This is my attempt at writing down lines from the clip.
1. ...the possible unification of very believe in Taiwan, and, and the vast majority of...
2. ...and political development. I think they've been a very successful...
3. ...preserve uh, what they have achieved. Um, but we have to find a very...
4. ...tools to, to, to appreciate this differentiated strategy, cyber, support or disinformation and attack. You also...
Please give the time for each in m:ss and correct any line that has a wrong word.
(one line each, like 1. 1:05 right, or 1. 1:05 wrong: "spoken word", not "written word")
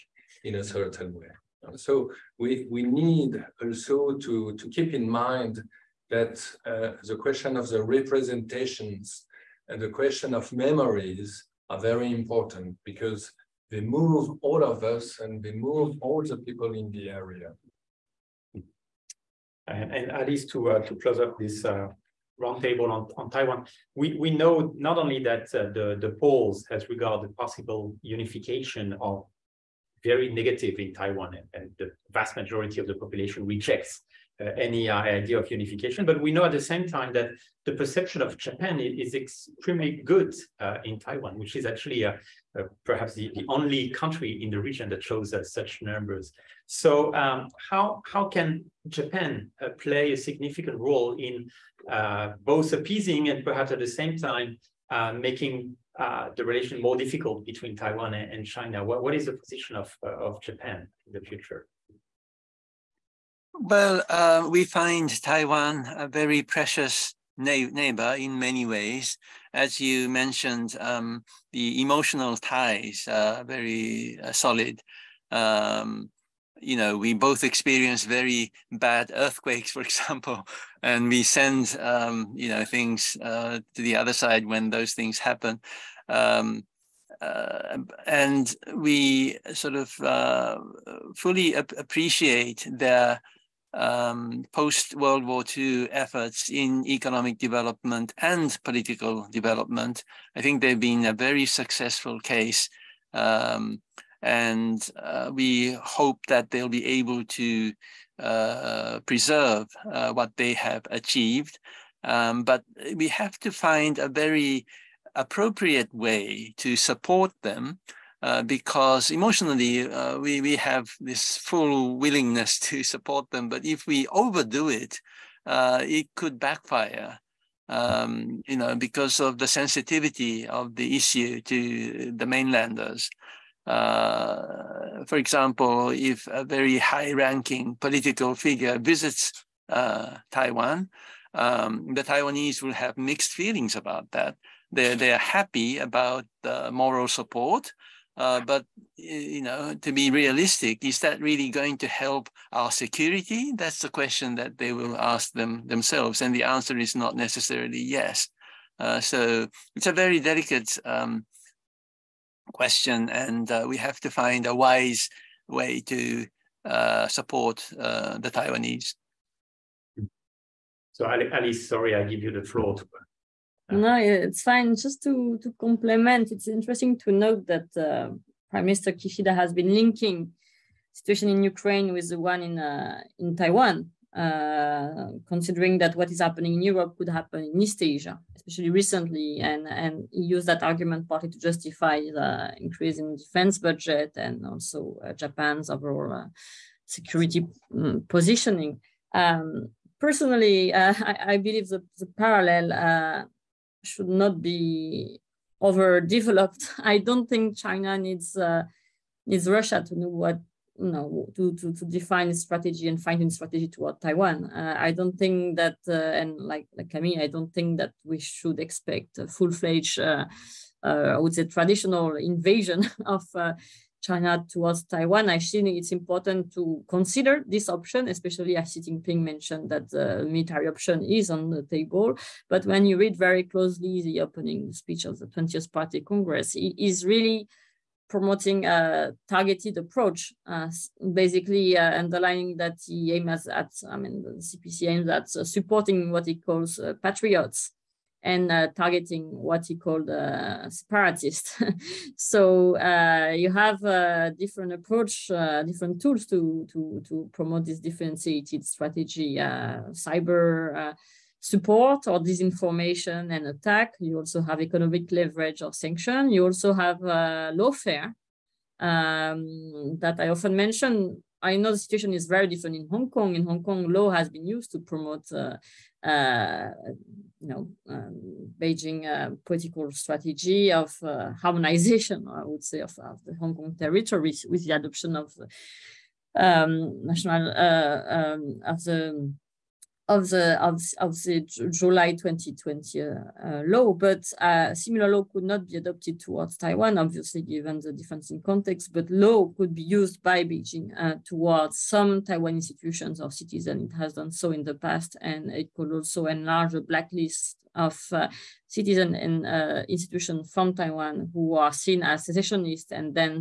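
1. 0:27 wrong: "negative", not "believe"
2. 1:38 right
3. 1:49 right
4. 4:16 wrong: "promote", not "appreciate".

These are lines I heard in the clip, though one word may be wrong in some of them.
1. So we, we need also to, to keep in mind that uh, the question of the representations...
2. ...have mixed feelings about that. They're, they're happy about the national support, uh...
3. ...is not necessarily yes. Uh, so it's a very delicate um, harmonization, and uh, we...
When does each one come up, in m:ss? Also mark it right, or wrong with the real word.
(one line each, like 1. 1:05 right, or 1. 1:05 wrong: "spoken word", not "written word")
1. 0:01 right
2. 2:22 wrong: "moral", not "national"
3. 2:36 wrong: "question", not "harmonization".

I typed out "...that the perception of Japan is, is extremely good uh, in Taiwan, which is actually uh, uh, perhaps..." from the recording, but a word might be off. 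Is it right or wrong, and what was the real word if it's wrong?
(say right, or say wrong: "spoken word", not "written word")
right.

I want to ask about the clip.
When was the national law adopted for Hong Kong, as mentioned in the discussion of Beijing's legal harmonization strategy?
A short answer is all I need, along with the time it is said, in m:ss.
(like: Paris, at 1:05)
July 2020, at 4:51.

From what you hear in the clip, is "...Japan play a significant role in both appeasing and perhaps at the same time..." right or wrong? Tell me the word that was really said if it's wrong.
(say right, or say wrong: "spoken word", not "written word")
right.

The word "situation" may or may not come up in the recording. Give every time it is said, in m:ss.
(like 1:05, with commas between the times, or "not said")
3:00, 4:31.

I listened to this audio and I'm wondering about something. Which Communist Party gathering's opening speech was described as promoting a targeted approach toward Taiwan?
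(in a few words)
20th Party Congress.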